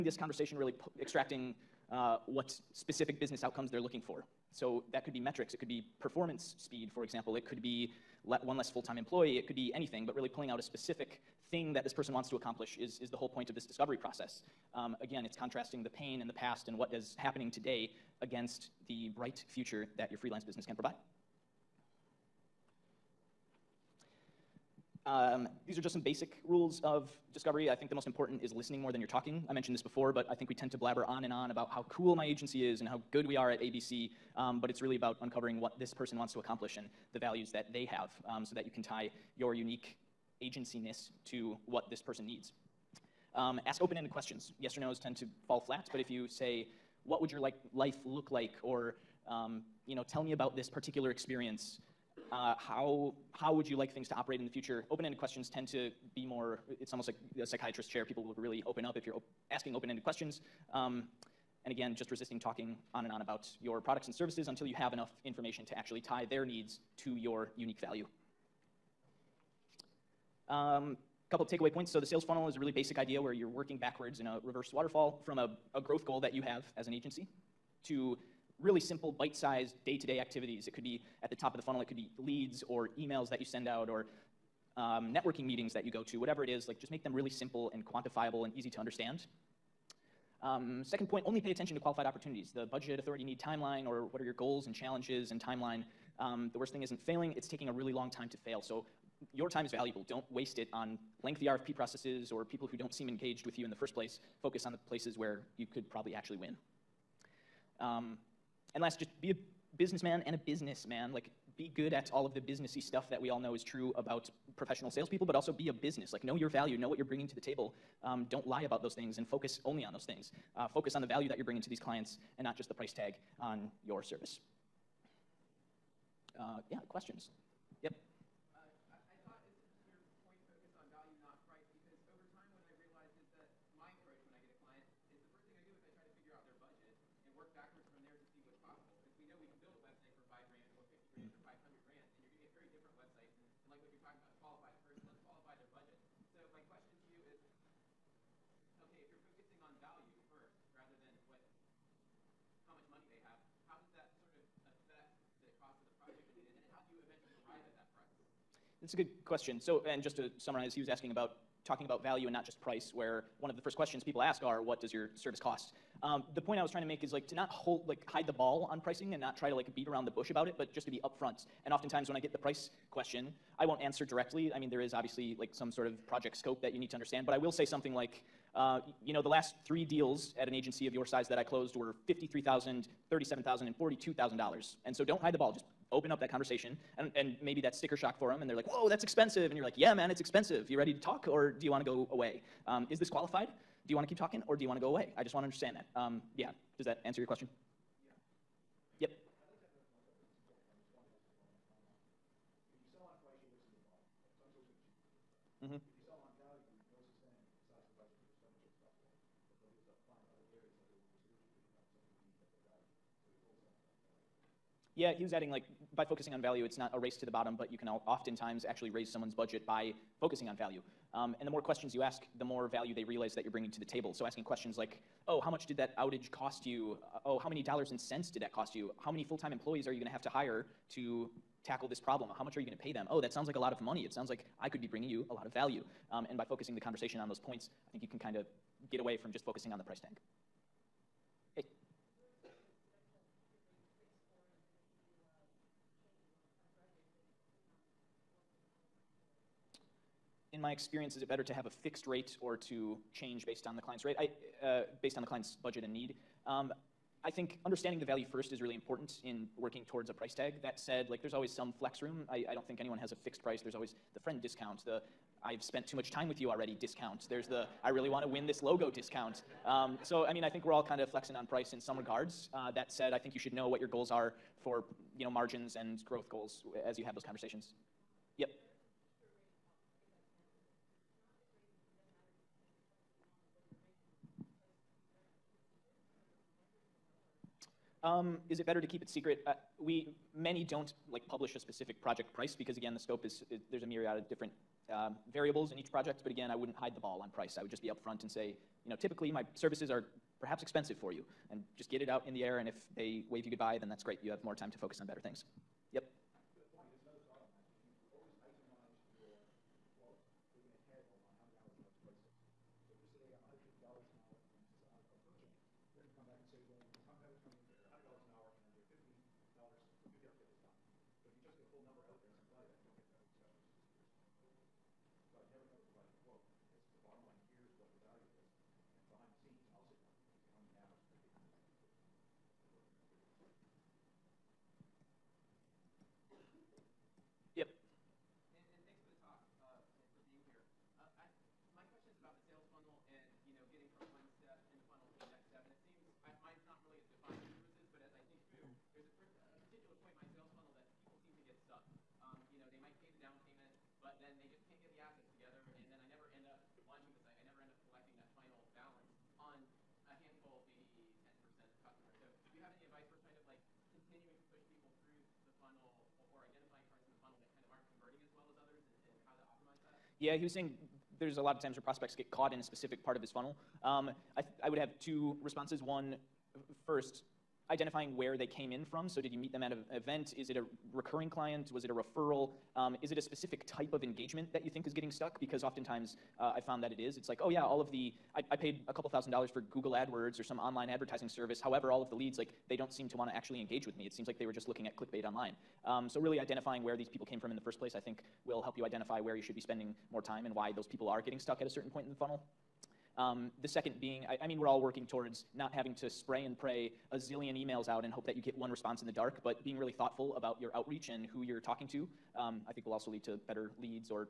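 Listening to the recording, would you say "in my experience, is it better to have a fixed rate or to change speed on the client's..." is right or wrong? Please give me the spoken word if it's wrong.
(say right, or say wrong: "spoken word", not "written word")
wrong: "based", not "speed".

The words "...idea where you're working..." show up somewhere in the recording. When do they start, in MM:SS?
01:12.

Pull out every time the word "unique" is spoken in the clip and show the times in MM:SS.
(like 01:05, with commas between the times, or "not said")
00:39, 01:07.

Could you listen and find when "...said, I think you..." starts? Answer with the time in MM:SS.
04:32.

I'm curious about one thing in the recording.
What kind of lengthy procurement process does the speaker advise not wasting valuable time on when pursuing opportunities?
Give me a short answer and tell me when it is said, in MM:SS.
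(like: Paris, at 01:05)
RFP processes, at 01:41.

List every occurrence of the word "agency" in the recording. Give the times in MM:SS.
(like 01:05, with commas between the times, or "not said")
00:32, 00:40, 01:16, 03:00.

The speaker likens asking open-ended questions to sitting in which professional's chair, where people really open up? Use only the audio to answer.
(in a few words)
A psychiatrist.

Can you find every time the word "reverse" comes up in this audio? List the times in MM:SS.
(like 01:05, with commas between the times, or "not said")
01:14.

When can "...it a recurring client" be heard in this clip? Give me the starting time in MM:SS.
06:20.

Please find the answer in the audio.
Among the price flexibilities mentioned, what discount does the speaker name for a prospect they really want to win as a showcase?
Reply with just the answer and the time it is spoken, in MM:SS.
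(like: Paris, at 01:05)
Logo discount, at 04:28.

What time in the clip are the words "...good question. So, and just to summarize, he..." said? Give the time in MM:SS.
02:38.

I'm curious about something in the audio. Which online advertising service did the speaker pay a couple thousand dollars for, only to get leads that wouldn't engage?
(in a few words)
Google AdWords.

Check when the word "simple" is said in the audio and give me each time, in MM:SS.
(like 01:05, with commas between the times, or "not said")
01:18, 01:27.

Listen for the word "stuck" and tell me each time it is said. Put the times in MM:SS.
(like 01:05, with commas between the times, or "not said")
06:25, 06:41.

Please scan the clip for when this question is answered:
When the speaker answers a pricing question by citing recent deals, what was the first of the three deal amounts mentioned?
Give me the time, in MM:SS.
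03:02.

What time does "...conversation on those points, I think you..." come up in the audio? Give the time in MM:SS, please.
03:56.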